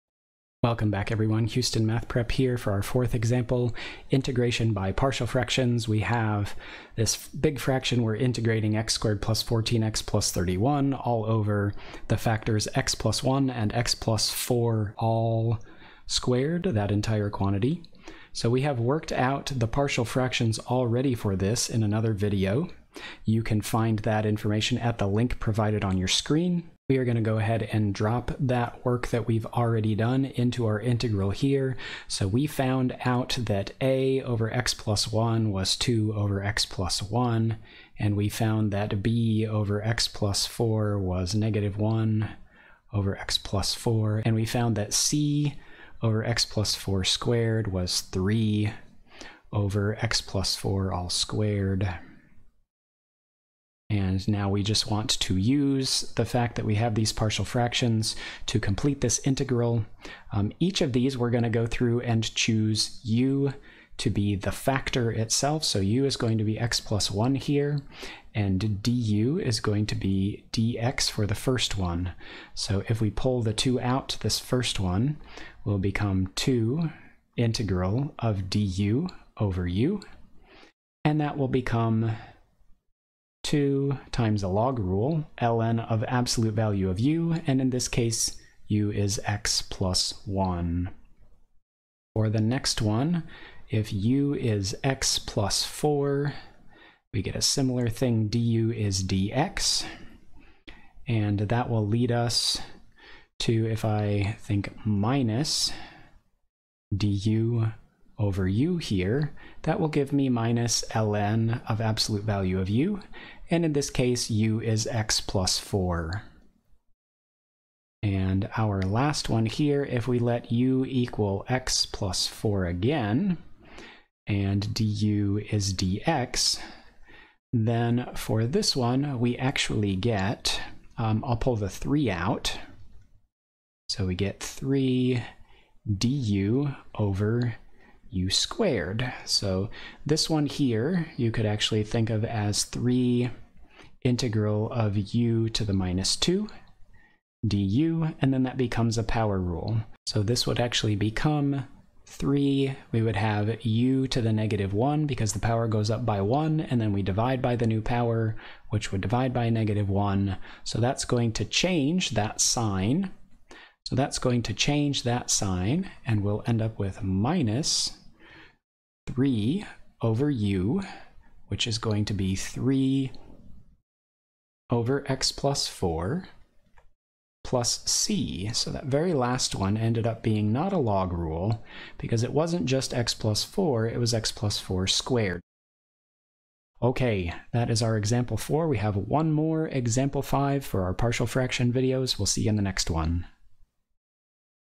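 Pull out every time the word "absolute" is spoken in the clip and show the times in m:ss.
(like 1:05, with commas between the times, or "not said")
1:26, 1:51.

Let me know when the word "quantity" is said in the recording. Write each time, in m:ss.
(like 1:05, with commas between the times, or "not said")
0:17.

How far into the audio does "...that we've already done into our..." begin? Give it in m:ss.
0:29.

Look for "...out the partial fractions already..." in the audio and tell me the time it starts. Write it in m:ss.
0:19.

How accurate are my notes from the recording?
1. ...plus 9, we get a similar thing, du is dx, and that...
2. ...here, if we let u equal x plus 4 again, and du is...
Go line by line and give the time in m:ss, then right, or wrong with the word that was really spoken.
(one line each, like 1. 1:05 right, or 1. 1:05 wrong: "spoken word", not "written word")
1. 1:35 wrong: "4", not "9"
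2. 1:59 right.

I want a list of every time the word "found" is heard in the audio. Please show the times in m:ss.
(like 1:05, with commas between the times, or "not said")
0:32, 0:38, 0:44.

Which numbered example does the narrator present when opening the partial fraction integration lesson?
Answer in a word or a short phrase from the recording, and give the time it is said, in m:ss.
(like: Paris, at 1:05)
fourth, at 0:02.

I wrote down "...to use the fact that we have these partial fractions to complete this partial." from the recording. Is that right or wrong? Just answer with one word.
wrong.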